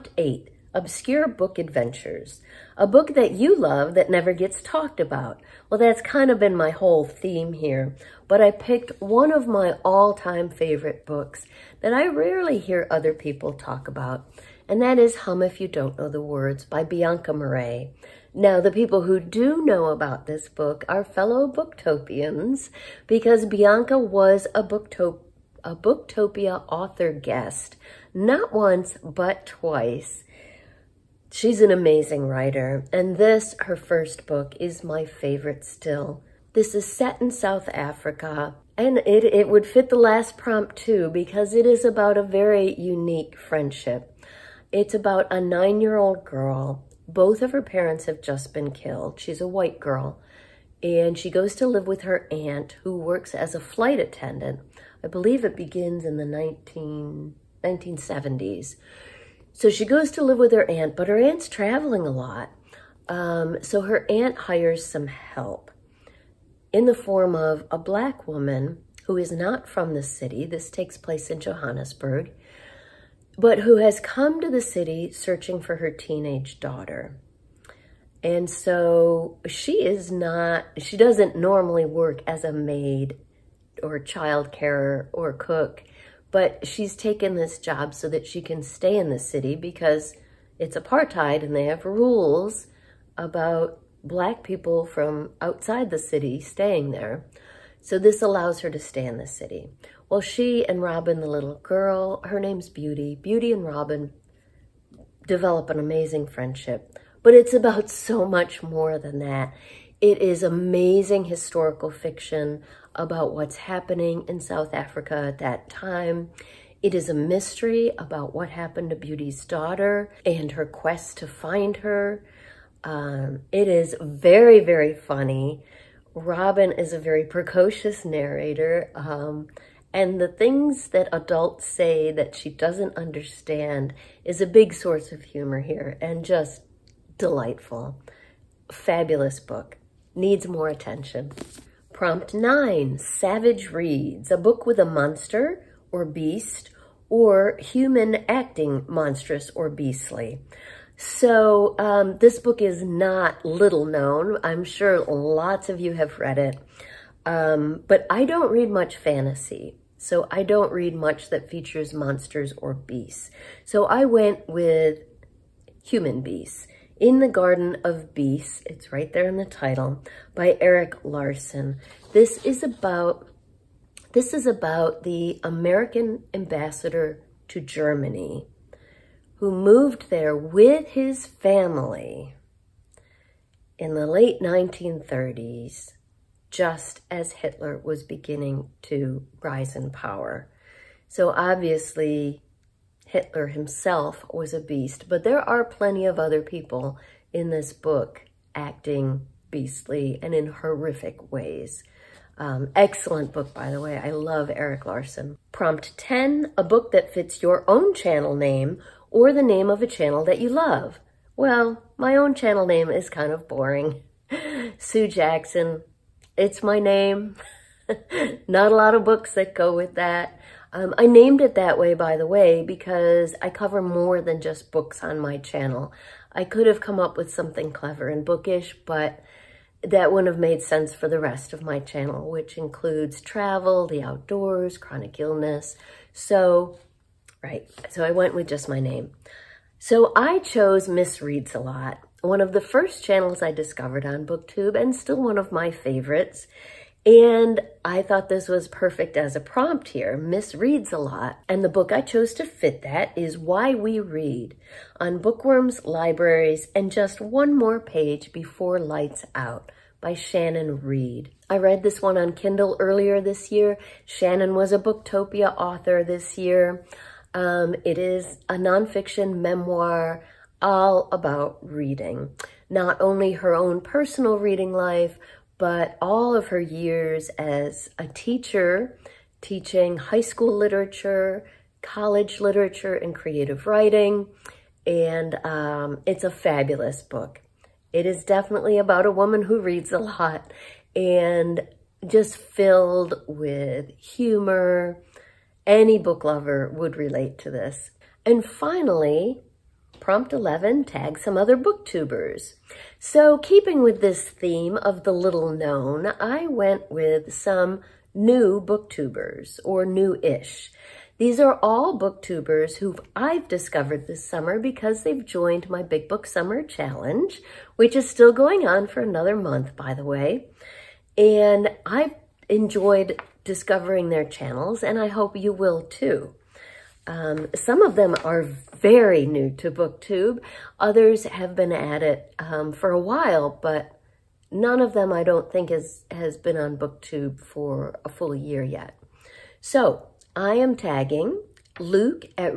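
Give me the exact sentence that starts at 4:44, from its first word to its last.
And um, it's a fabulous book.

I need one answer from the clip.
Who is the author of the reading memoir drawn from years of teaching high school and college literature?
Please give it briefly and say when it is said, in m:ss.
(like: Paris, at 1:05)
Shannon Reed, at 4:20.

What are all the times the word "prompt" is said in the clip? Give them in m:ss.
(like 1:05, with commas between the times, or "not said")
0:40, 2:21, 3:25, 4:09, 4:59.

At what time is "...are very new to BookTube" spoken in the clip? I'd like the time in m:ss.
5:28.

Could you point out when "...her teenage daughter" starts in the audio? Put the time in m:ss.
1:15.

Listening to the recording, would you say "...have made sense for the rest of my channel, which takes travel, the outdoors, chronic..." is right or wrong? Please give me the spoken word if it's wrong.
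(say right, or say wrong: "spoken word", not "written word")
wrong: "includes", not "takes".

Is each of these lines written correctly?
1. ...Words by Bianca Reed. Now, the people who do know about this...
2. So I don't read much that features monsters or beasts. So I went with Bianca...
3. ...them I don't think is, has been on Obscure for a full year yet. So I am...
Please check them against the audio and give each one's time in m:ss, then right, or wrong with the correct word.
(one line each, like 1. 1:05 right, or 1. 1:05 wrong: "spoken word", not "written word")
1. 0:16 wrong: "Marais", not "Reed"
2. 2:39 wrong: "Human", not "Bianca"
3. 5:34 wrong: "BookTube", not "Obscure".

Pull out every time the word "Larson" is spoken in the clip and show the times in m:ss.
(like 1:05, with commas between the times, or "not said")
2:51, 3:24.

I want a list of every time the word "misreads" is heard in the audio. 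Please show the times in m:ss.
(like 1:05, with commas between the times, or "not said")
4:00, 4:10.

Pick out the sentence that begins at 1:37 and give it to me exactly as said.
So this allows her to stay in the city.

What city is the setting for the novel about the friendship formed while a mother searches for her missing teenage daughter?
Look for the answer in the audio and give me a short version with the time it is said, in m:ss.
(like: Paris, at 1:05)
Johannesburg, at 1:11.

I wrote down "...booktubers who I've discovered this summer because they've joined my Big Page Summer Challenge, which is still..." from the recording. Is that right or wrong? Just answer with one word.
wrong.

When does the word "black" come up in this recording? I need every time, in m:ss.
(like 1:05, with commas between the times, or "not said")
1:07, 1:34.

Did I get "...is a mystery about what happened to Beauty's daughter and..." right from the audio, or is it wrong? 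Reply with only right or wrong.
right.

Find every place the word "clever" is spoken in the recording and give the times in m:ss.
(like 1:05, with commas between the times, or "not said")
3:47.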